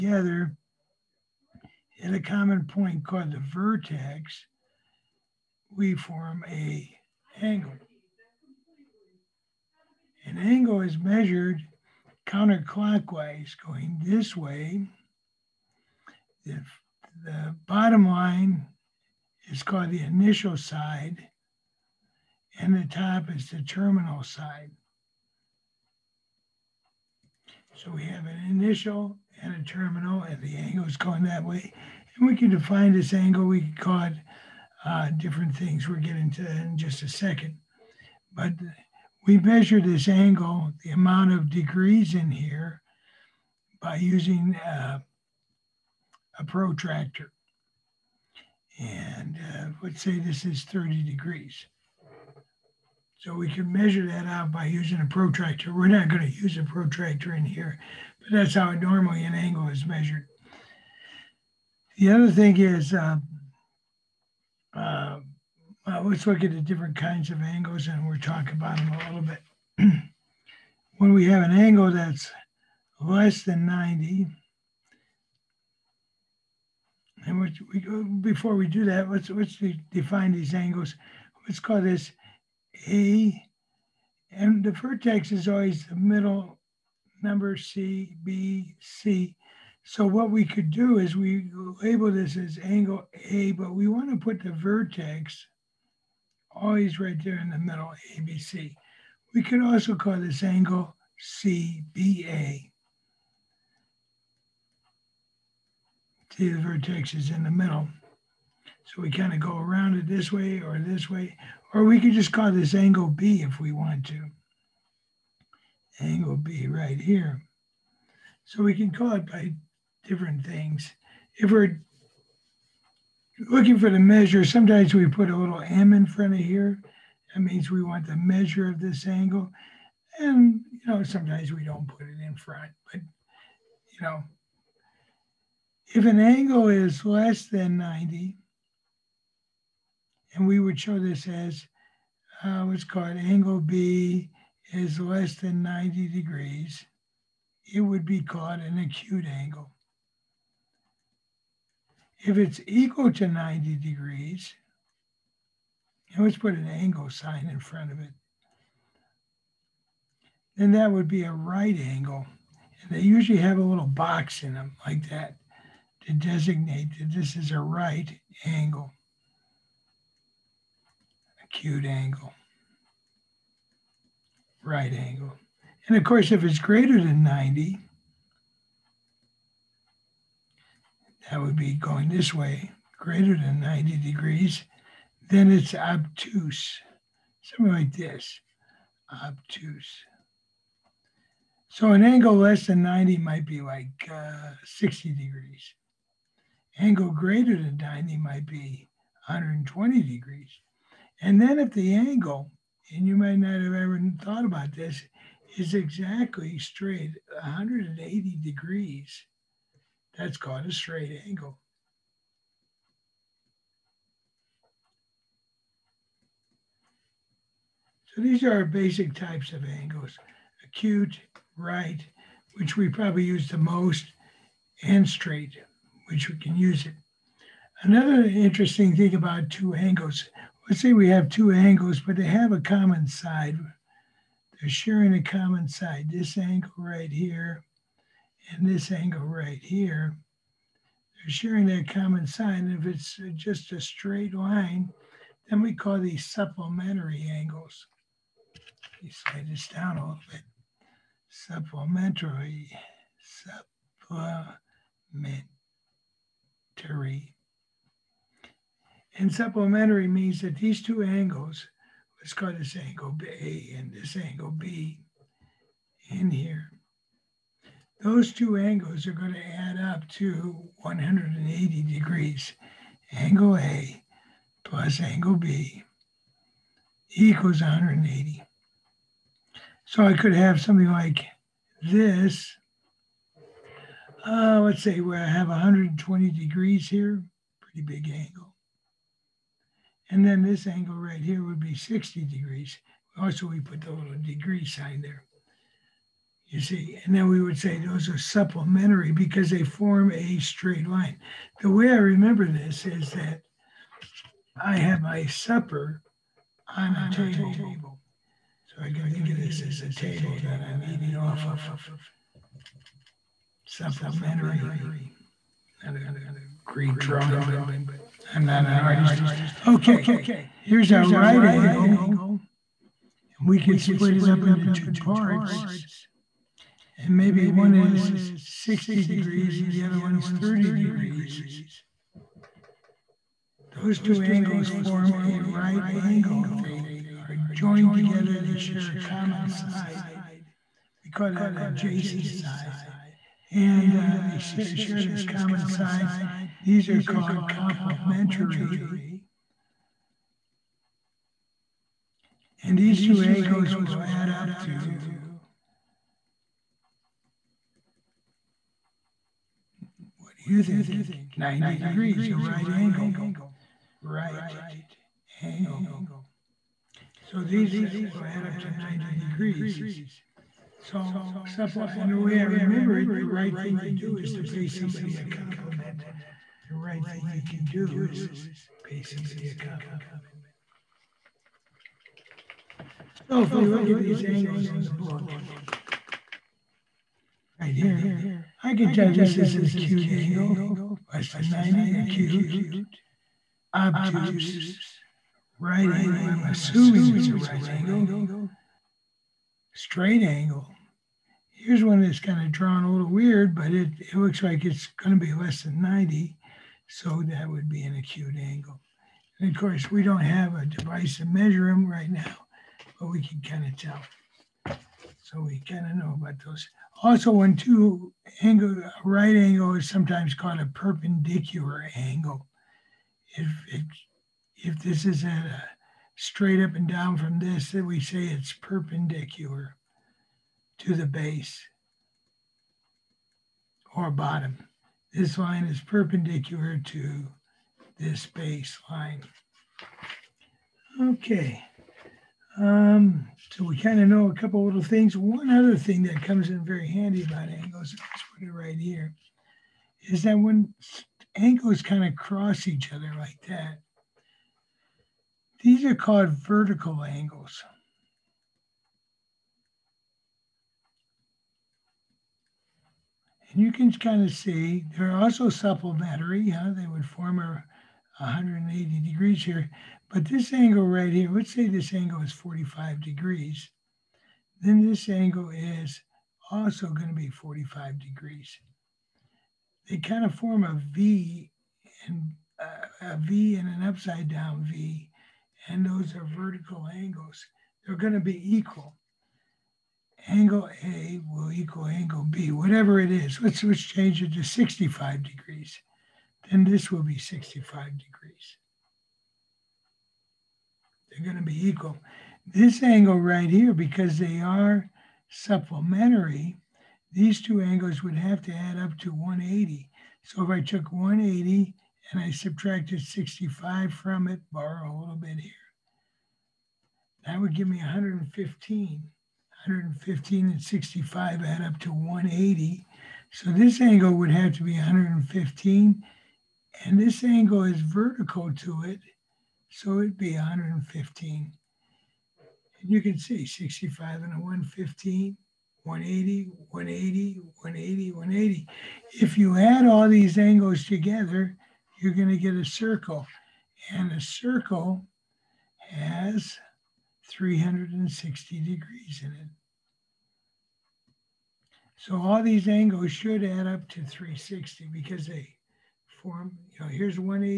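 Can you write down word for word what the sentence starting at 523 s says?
So this angle would have to be 115 and this angle is vertical to it.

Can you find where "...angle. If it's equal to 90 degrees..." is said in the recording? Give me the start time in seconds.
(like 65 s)
149 s.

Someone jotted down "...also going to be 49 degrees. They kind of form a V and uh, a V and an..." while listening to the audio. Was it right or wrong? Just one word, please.
wrong.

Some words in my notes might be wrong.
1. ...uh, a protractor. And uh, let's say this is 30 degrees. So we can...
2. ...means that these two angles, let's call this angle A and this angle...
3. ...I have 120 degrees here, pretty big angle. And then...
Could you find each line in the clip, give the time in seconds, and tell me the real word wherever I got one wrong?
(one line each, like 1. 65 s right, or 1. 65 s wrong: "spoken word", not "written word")
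1. 44 s right
2. 260 s right
3. 285 s right.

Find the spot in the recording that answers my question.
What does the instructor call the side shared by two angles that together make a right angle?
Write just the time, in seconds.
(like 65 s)
341 s.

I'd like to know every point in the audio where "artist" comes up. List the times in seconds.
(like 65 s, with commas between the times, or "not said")
318 s.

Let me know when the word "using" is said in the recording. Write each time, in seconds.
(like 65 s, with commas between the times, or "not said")
43 s, 54 s.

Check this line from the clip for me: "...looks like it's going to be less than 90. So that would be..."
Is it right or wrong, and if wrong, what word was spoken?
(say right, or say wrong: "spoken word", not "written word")
right.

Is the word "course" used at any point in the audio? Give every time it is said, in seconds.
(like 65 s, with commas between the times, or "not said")
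176 s, 409 s.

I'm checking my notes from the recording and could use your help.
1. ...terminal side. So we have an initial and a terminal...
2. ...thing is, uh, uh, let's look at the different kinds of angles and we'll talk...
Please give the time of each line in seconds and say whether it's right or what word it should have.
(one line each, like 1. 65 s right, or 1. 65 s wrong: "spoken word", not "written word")
1. 23 s right
2. 62 s right.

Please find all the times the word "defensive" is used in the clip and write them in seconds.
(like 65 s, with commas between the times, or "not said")
not said.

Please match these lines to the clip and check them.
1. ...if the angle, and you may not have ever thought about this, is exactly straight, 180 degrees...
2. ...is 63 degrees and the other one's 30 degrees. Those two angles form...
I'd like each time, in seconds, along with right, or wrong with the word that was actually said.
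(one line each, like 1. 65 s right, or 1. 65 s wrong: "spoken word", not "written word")
1. 201 s right
2. 327 s wrong: "60", not "63".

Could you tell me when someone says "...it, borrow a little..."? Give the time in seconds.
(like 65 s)
514 s.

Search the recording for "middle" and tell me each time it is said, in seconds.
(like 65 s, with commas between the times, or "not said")
85 s, 97 s, 107 s.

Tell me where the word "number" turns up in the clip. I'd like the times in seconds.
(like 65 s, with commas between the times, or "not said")
87 s.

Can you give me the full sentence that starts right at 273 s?
Angle A plus angle B equals 180.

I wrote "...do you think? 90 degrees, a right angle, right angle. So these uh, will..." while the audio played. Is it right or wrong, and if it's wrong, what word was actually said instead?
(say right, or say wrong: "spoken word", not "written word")
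right.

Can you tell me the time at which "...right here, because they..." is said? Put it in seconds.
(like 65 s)
503 s.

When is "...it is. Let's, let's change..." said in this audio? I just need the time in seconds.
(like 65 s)
493 s.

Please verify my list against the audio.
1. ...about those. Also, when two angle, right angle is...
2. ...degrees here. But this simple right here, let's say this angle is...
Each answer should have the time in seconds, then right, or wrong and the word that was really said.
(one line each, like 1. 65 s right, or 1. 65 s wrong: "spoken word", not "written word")
1. 416 s right
2. 469 s wrong: "angle", not "simple".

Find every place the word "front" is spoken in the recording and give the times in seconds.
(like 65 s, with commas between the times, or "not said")
126 s, 132 s, 157 s.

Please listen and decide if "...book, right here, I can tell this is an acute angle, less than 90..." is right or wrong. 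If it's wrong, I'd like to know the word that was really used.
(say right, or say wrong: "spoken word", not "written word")
right.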